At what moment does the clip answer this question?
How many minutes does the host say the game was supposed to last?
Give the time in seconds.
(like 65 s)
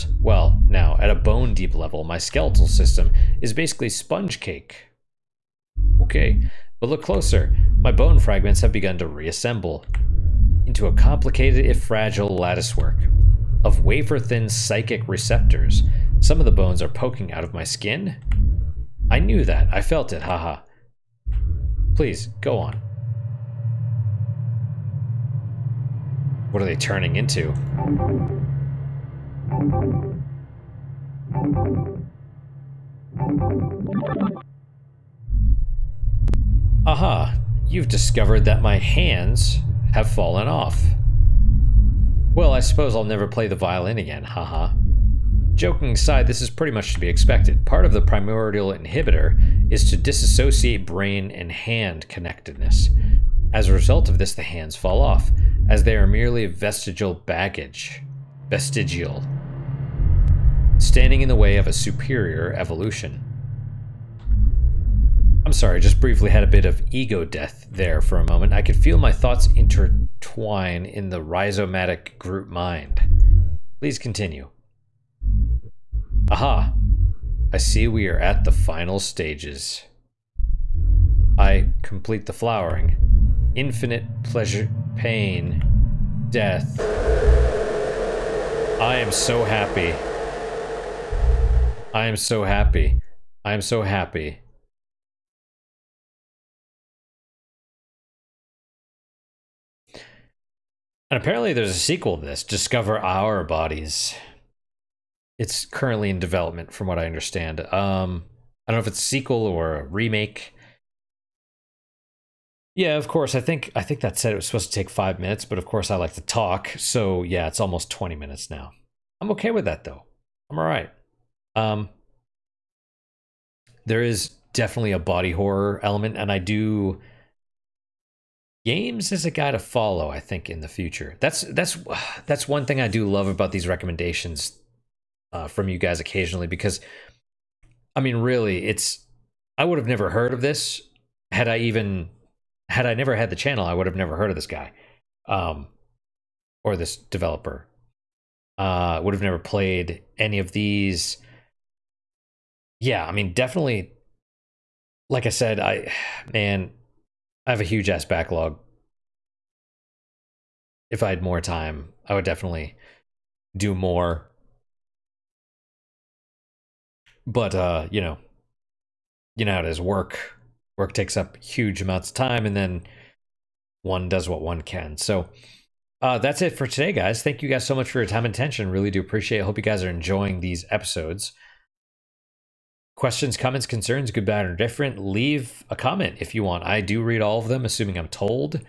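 114 s.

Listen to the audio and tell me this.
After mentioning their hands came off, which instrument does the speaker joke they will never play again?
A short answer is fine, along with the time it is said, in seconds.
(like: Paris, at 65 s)
violin, at 43 s.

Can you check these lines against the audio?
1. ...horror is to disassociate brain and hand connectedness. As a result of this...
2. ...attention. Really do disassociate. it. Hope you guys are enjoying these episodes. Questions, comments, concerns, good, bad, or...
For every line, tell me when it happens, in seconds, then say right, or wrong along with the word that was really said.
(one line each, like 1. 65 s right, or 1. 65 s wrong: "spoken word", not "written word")
1. 48 s wrong: "inhibitor", not "horror"
2. 178 s wrong: "appreciate", not "disassociate".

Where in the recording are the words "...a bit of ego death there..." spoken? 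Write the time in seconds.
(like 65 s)
66 s.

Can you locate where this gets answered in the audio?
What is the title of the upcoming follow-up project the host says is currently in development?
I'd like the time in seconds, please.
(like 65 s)
102 s.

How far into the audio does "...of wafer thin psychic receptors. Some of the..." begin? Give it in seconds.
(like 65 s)
13 s.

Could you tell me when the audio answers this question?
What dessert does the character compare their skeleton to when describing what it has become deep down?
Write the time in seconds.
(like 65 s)
3 s.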